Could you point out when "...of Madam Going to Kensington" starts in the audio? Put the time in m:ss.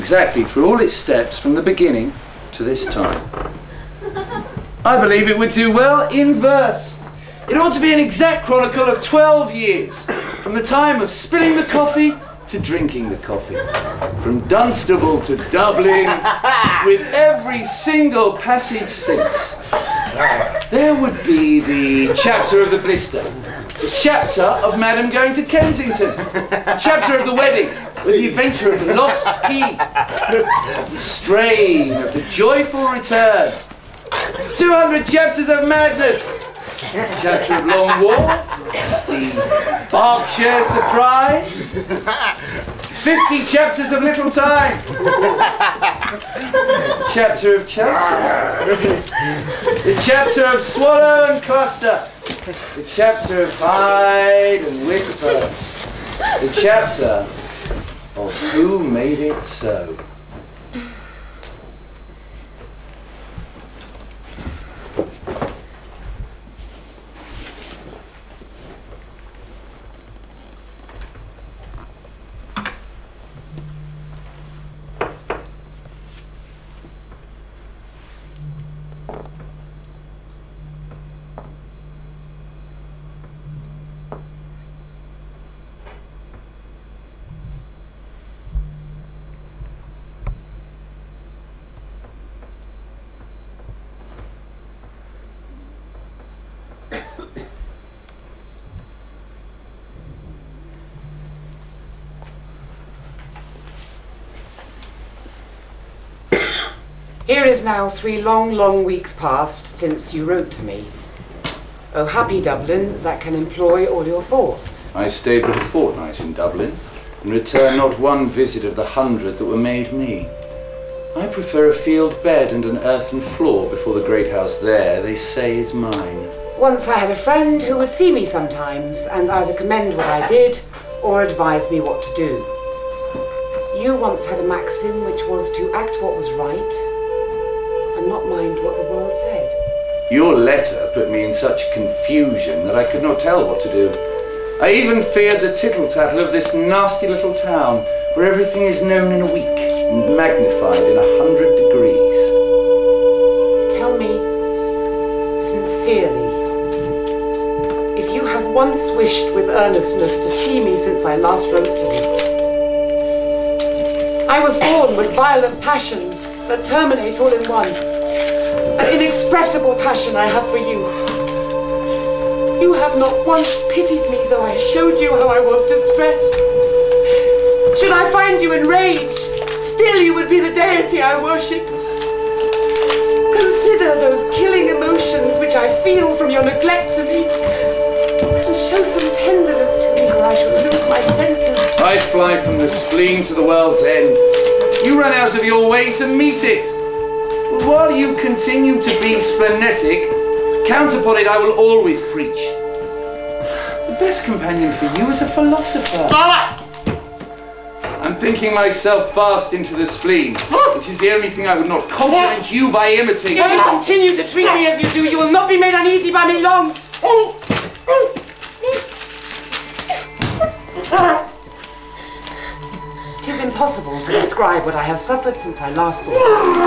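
0:24.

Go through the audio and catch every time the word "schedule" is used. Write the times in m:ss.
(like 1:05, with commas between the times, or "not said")
not said.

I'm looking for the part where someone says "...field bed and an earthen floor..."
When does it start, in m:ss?
2:01.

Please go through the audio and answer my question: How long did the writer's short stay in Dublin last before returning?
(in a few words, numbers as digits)
a fortnight.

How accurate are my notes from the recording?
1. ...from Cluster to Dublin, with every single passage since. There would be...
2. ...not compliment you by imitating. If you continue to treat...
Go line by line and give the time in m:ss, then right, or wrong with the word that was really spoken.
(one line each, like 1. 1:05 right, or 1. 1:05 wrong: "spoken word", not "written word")
1. 0:14 wrong: "Dunstable", not "Cluster"
2. 3:31 right.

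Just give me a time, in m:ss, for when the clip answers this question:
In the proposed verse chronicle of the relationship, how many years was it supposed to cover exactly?
0:08.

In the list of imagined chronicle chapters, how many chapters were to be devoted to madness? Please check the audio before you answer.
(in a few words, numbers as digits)
200.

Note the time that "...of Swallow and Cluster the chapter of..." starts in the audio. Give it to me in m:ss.
0:50.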